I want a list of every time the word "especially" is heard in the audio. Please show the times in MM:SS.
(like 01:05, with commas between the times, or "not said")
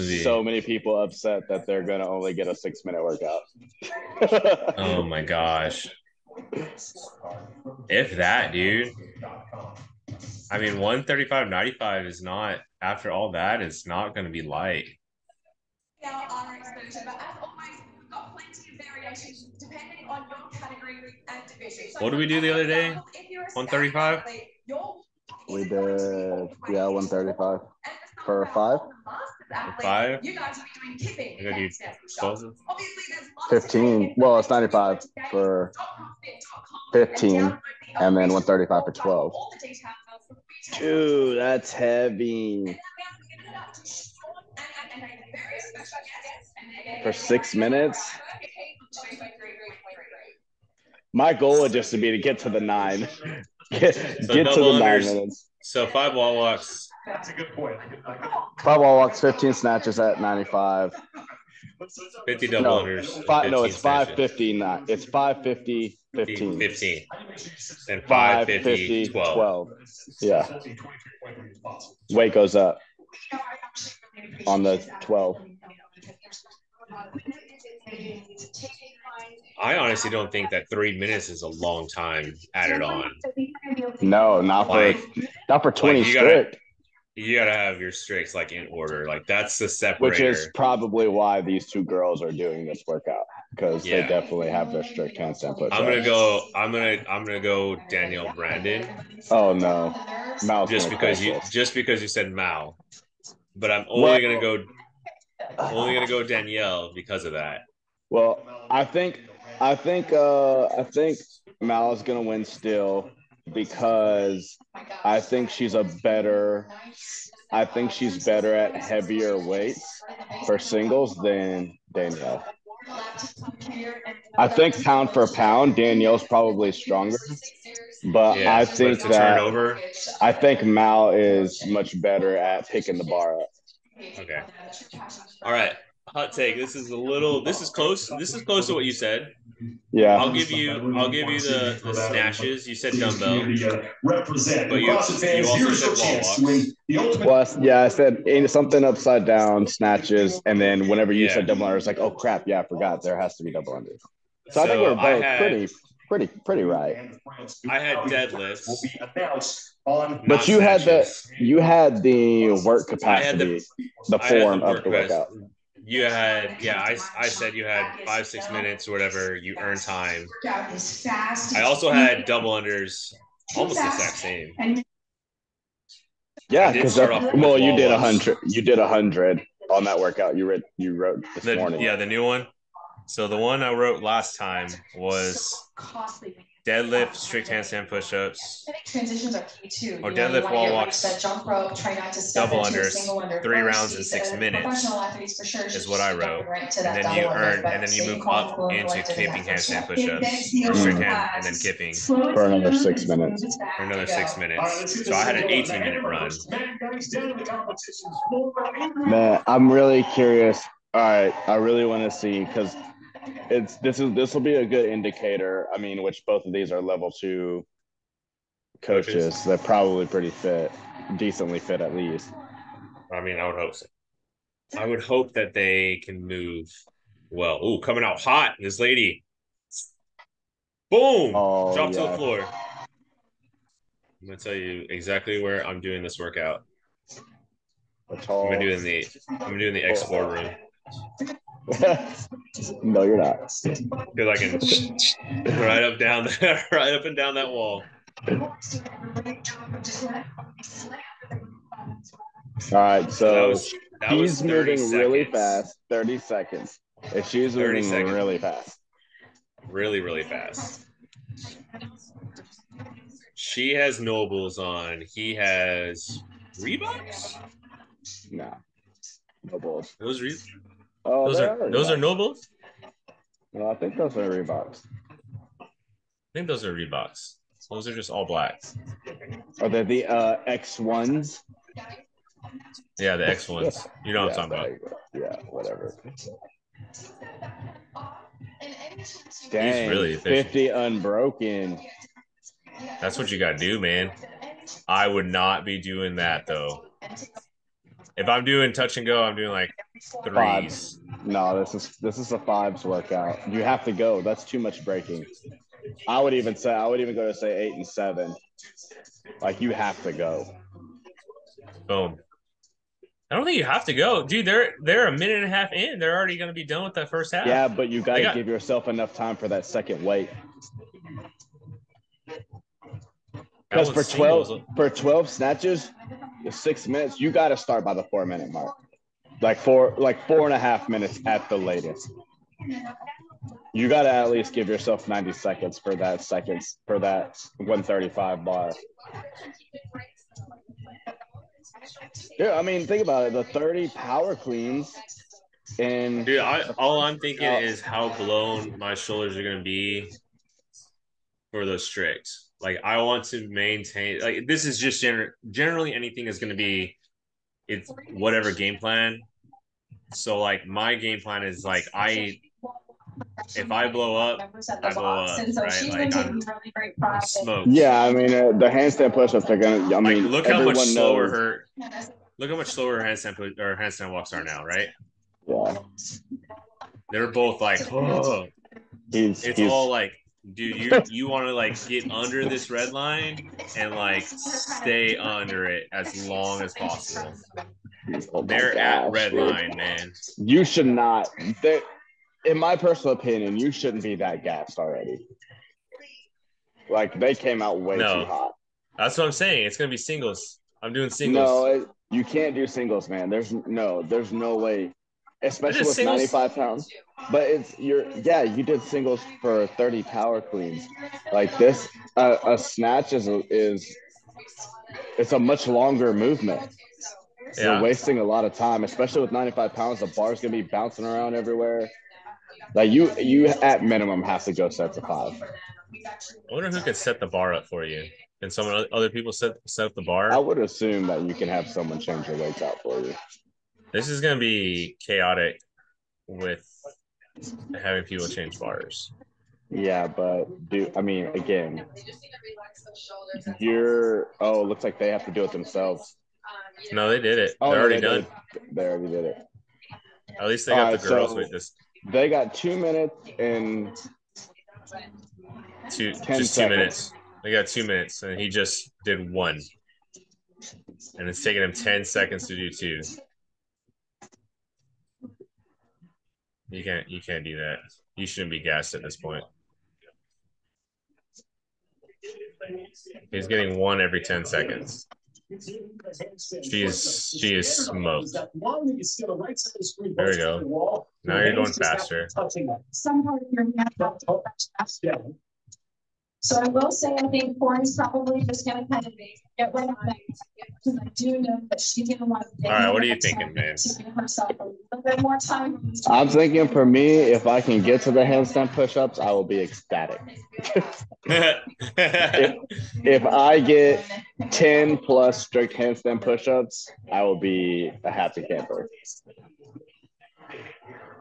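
06:45, 06:58.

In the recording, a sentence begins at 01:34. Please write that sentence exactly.
they definitely have their strict handstand push.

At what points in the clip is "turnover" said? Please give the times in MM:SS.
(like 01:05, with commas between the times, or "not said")
02:09.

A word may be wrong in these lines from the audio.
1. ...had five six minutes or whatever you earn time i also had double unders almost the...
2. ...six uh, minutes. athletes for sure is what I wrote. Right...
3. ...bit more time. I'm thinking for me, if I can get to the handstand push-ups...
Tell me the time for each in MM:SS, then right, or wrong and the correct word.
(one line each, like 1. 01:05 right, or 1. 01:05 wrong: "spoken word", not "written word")
1. 02:47 right
2. 03:14 right
3. 08:15 right.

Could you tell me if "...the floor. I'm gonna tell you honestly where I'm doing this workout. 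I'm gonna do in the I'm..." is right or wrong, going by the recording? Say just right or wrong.
wrong.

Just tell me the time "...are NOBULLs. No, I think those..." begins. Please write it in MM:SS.
04:31.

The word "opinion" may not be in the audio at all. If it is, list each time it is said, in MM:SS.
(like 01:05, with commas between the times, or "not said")
06:33.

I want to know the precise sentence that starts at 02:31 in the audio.
said double under, it's like, oh crap, yeah, I forgot there has to be double under.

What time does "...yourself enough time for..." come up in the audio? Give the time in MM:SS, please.
05:18.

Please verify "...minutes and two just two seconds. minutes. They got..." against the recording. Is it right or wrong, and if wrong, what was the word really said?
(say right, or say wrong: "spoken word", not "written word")
right.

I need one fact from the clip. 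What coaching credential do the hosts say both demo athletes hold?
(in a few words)
Level two coaches.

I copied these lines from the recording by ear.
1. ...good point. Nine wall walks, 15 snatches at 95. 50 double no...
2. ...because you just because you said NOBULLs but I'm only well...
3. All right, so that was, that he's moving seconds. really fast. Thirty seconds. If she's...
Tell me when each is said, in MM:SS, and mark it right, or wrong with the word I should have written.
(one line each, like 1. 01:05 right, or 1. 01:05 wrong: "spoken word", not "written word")
1. 00:57 wrong: "Five", not "Nine"
2. 01:40 wrong: "Mal", not "NOBULLs"
3. 04:08 right.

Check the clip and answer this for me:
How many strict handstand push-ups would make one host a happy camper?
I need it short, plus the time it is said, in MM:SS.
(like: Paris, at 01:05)
10, at 08:24.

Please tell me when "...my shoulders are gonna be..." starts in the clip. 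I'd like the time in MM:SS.
05:48.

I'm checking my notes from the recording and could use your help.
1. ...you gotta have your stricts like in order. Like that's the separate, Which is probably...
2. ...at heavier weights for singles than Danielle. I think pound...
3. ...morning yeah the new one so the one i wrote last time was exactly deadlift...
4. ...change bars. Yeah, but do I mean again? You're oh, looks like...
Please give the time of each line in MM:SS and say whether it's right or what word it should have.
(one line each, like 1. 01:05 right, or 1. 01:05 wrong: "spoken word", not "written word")
1. 01:27 right
2. 01:58 right
3. 03:01 wrong: "costly", not "exactly"
4. 07:18 right.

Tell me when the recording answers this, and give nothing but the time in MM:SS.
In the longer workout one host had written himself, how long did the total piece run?
03:25.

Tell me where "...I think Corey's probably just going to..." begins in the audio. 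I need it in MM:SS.
08:07.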